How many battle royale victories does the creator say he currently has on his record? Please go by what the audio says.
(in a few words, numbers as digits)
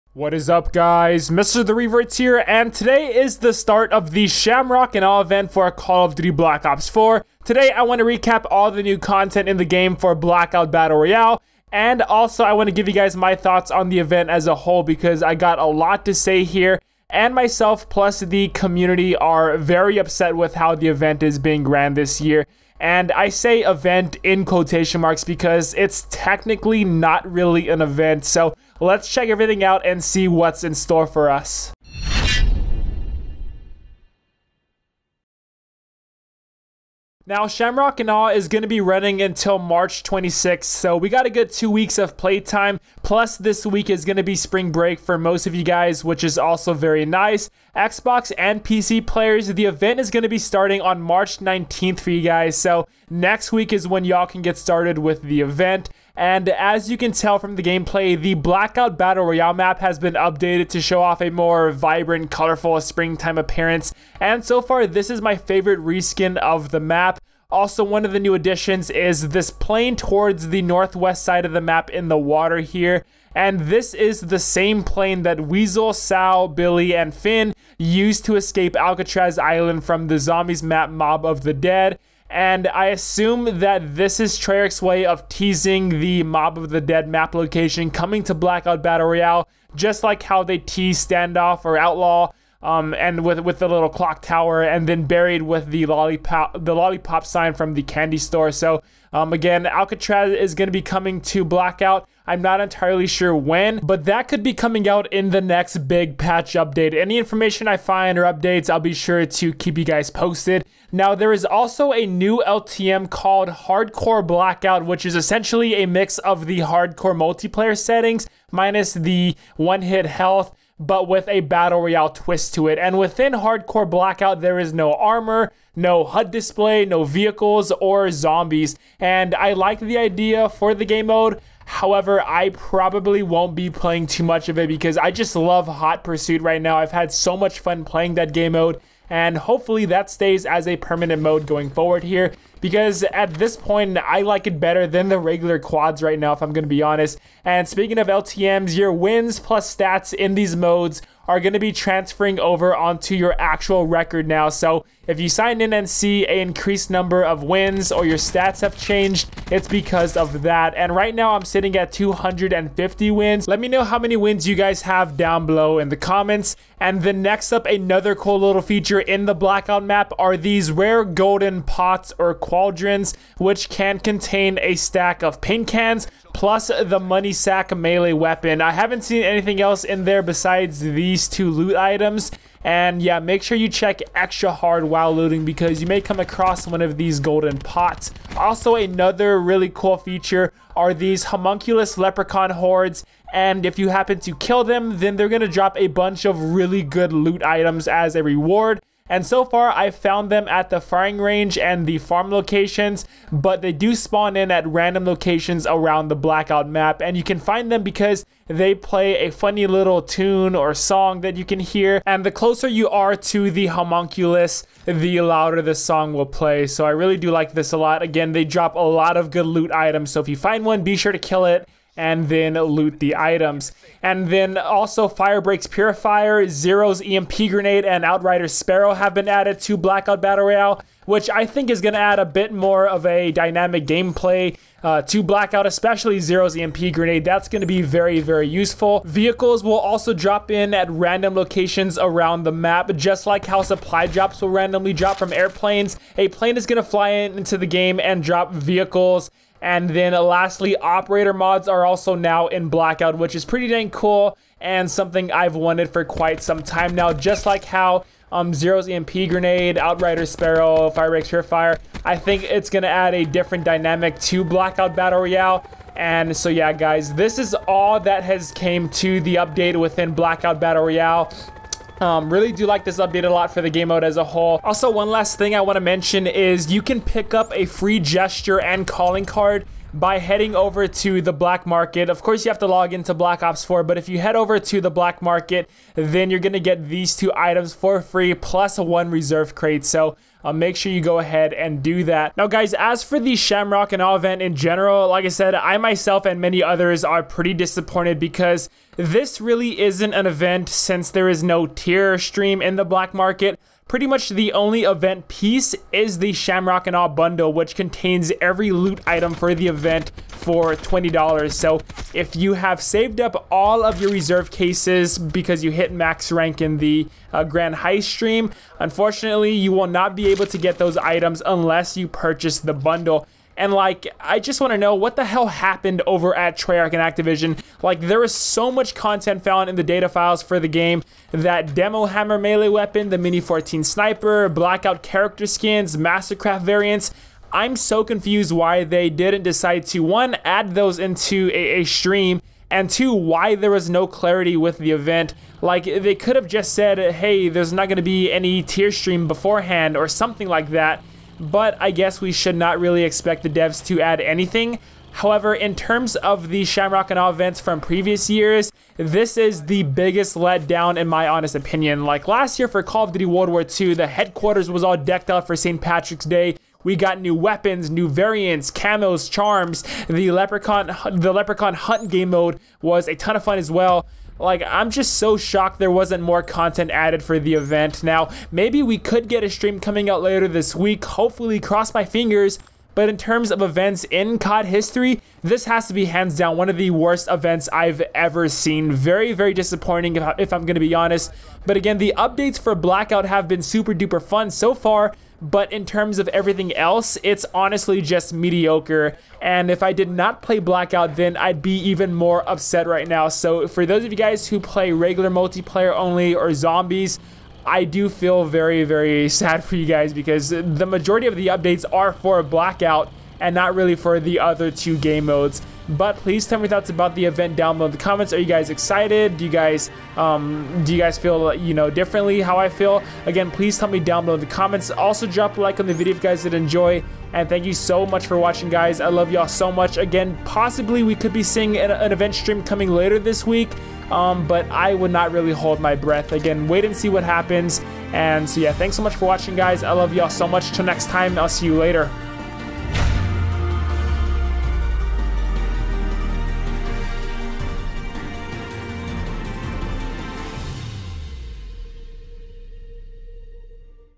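250.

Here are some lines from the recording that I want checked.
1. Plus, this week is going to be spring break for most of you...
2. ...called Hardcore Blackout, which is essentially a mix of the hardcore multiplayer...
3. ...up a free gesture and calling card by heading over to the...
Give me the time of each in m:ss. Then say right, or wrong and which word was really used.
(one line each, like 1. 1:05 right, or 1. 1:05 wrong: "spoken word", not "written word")
1. 0:43 right
2. 1:53 right
3. 4:37 right.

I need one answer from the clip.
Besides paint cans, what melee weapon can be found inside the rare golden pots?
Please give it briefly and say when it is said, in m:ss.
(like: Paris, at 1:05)
money sack, at 2:56.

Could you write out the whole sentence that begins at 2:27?
And speaking of LTMs, your wins plus stats in these modes are going to be transferring over onto your actual record now.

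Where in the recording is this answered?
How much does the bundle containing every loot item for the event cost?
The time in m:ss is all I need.
5:10.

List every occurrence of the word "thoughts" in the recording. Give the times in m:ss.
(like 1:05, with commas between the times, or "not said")
0:13, 6:56.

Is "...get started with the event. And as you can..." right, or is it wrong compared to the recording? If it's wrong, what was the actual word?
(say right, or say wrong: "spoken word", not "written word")
right.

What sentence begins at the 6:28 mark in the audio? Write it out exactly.
Very, very disappointing if, I'm going to be honest.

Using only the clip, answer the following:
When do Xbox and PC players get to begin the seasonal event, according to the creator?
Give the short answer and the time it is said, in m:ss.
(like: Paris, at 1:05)
March 19th, at 0:50.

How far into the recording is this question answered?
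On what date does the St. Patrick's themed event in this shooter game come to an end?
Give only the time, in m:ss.
0:39.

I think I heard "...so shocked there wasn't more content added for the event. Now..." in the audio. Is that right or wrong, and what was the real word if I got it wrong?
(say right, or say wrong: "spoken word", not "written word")
right.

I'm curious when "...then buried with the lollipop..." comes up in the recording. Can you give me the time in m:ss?
1:34.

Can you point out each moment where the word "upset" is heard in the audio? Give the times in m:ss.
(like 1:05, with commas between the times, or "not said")
0:19, 6:42.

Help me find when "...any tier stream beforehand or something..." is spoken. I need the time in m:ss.
5:48.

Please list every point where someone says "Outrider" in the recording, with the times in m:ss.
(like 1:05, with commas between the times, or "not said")
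3:48, 4:19.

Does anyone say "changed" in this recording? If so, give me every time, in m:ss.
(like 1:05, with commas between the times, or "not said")
2:38.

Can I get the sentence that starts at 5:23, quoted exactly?
And like, I just want to know what the hell happened over at Treyarch and Activision.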